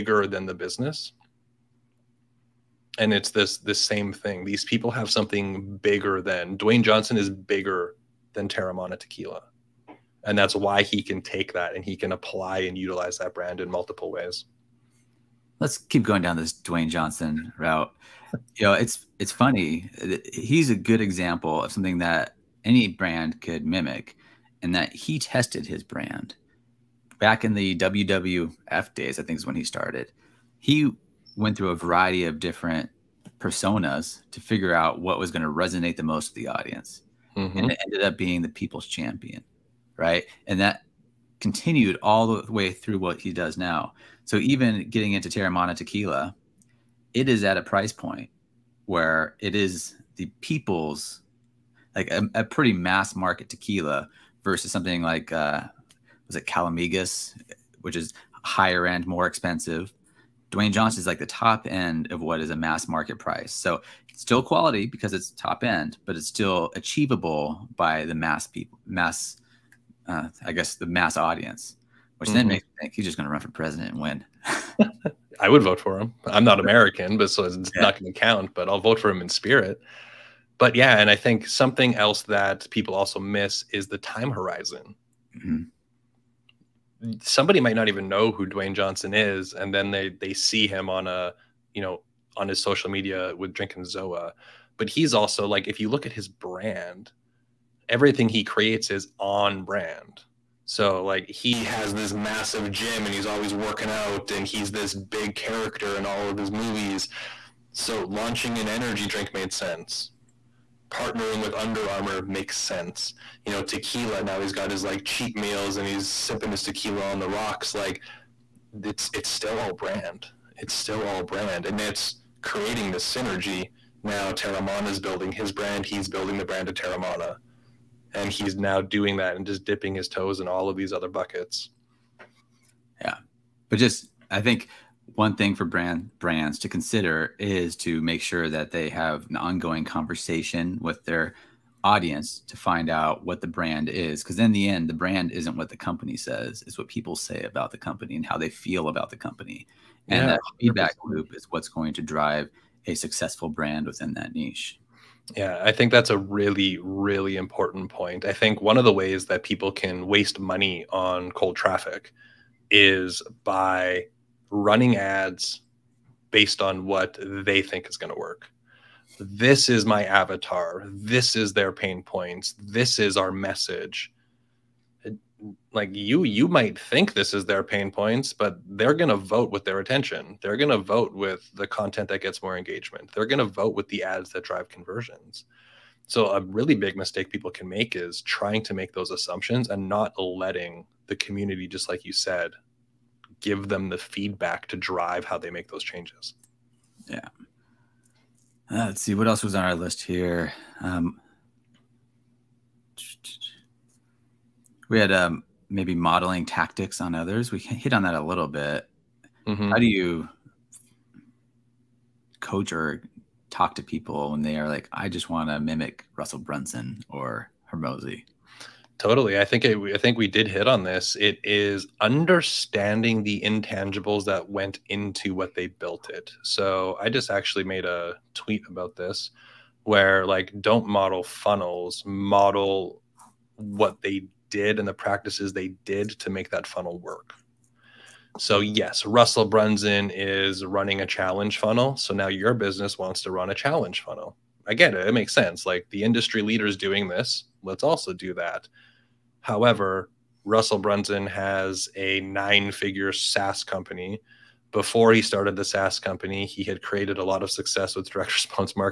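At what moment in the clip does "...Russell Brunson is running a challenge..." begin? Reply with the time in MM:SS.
03:59.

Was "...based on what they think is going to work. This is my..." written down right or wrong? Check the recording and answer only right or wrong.
right.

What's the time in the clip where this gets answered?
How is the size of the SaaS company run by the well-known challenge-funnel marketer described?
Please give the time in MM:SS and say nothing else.
04:12.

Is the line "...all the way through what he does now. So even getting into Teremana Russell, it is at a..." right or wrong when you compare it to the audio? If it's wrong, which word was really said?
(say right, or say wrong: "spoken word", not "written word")
wrong: "Tequila", not "Russell".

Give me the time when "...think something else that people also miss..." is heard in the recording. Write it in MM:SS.
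01:21.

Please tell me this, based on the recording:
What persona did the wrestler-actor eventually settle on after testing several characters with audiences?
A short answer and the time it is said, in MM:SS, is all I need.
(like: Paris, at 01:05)
The people's champion, at 00:38.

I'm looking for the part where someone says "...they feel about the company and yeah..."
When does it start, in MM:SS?
02:28.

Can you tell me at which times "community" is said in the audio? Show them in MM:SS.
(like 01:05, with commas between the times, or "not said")
03:11.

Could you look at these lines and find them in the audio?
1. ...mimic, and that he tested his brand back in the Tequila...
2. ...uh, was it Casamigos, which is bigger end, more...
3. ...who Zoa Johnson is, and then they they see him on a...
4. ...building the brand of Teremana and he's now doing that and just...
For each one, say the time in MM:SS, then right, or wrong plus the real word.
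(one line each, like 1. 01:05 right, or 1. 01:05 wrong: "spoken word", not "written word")
1. 00:23 wrong: "WWF", not "Tequila"
2. 00:55 wrong: "higher", not "bigger"
3. 01:28 wrong: "Dwayne", not "Zoa"
4. 02:06 right.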